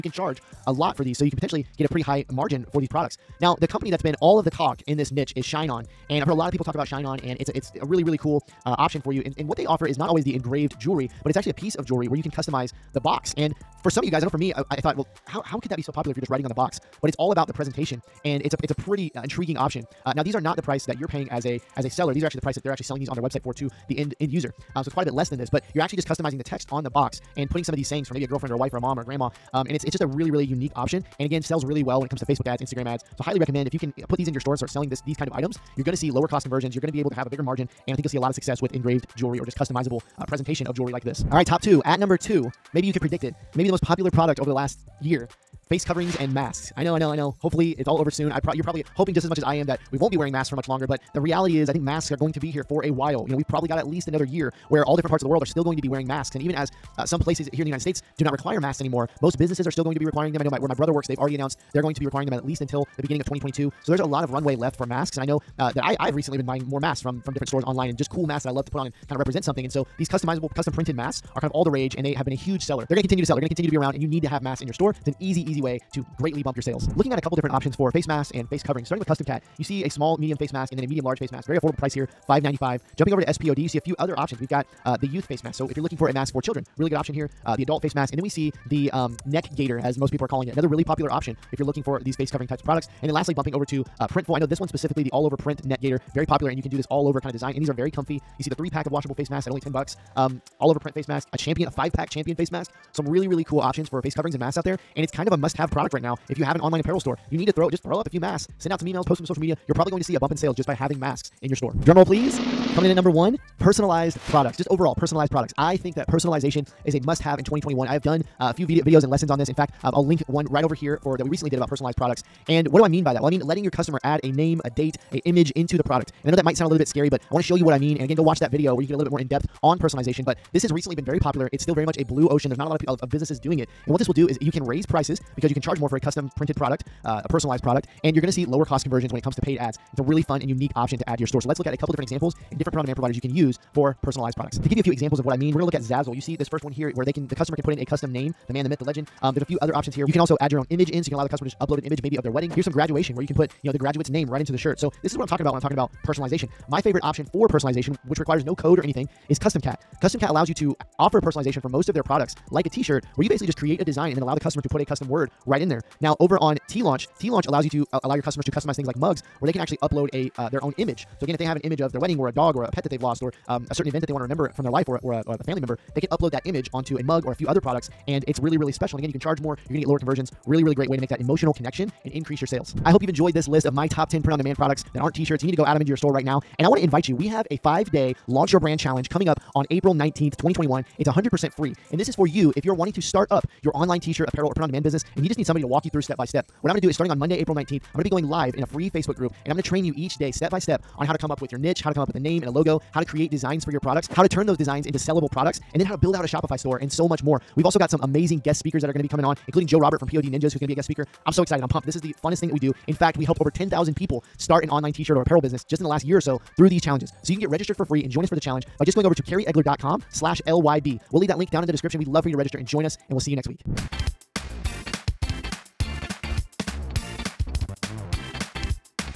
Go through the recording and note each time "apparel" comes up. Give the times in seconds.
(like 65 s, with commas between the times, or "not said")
106 s, 194 s, 215 s.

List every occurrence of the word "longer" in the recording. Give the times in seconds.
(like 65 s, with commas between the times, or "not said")
50 s.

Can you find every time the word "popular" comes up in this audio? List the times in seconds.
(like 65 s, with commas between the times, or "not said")
15 s, 43 s, 90 s, 96 s, 131 s.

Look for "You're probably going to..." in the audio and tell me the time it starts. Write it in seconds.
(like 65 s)
109 s.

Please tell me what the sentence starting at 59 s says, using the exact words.
Most businesses are still going to be requiring them.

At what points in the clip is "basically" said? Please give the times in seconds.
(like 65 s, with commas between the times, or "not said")
163 s.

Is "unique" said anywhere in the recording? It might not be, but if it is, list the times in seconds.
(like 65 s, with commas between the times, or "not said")
30 s, 140 s.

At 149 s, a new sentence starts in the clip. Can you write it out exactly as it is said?
Um, there's a few other options here.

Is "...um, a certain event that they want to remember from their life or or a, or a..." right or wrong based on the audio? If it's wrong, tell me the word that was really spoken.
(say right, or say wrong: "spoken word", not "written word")
right.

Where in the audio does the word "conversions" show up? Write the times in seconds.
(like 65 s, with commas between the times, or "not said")
36 s, 138 s, 179 s.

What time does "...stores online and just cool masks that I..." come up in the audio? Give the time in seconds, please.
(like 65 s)
67 s.